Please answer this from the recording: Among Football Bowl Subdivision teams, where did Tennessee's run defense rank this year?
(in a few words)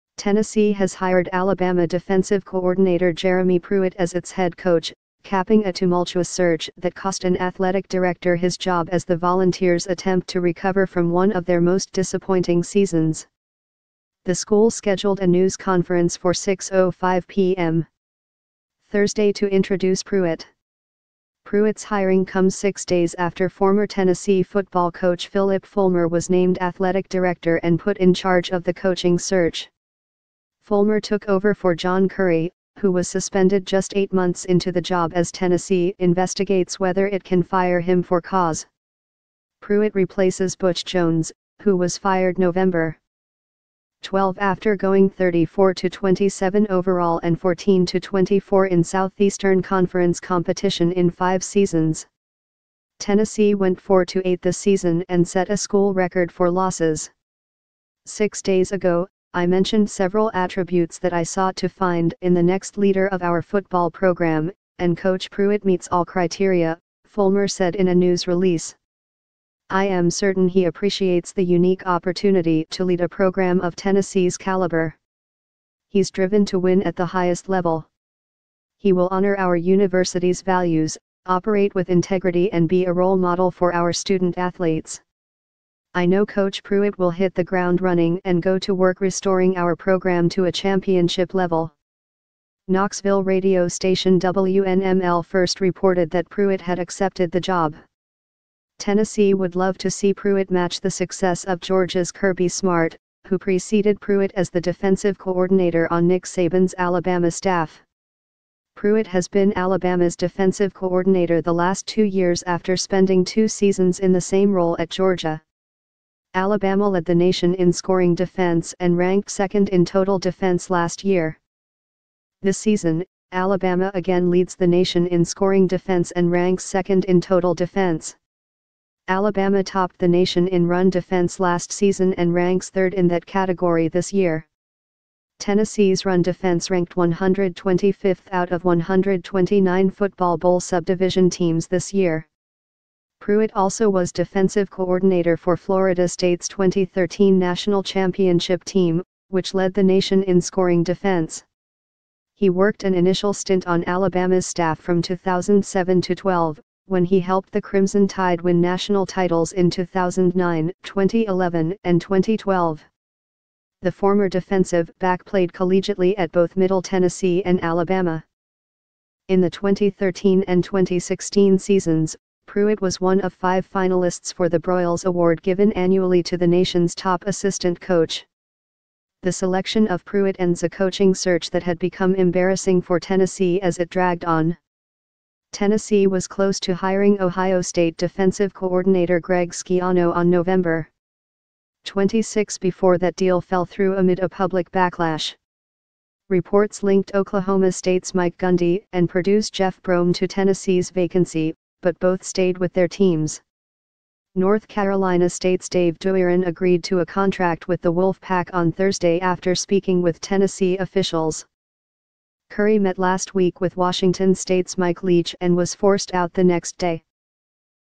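125th.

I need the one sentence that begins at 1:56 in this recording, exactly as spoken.
Alabama led the nation in scoring defense and ranked second in total defense last year.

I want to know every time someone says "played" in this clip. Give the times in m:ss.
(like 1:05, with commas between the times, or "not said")
2:45.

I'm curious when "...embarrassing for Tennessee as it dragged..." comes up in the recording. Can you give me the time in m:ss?
3:02.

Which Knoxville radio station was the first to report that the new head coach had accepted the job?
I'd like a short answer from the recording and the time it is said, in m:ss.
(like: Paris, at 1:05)
WNML, at 1:34.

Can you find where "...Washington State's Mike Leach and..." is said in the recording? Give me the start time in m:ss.
3:33.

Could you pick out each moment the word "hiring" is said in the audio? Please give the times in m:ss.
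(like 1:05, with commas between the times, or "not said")
0:21, 3:06.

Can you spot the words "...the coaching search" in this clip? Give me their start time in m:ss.
0:28.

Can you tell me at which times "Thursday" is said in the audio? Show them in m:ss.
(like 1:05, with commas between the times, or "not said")
0:18, 3:28.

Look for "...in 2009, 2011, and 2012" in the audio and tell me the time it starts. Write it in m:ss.
2:39.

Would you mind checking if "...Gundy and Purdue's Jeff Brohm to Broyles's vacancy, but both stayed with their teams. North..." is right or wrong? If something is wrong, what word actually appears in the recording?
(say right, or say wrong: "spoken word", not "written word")
wrong: "Tennessee", not "Broyles".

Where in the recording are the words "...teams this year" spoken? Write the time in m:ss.
2:21.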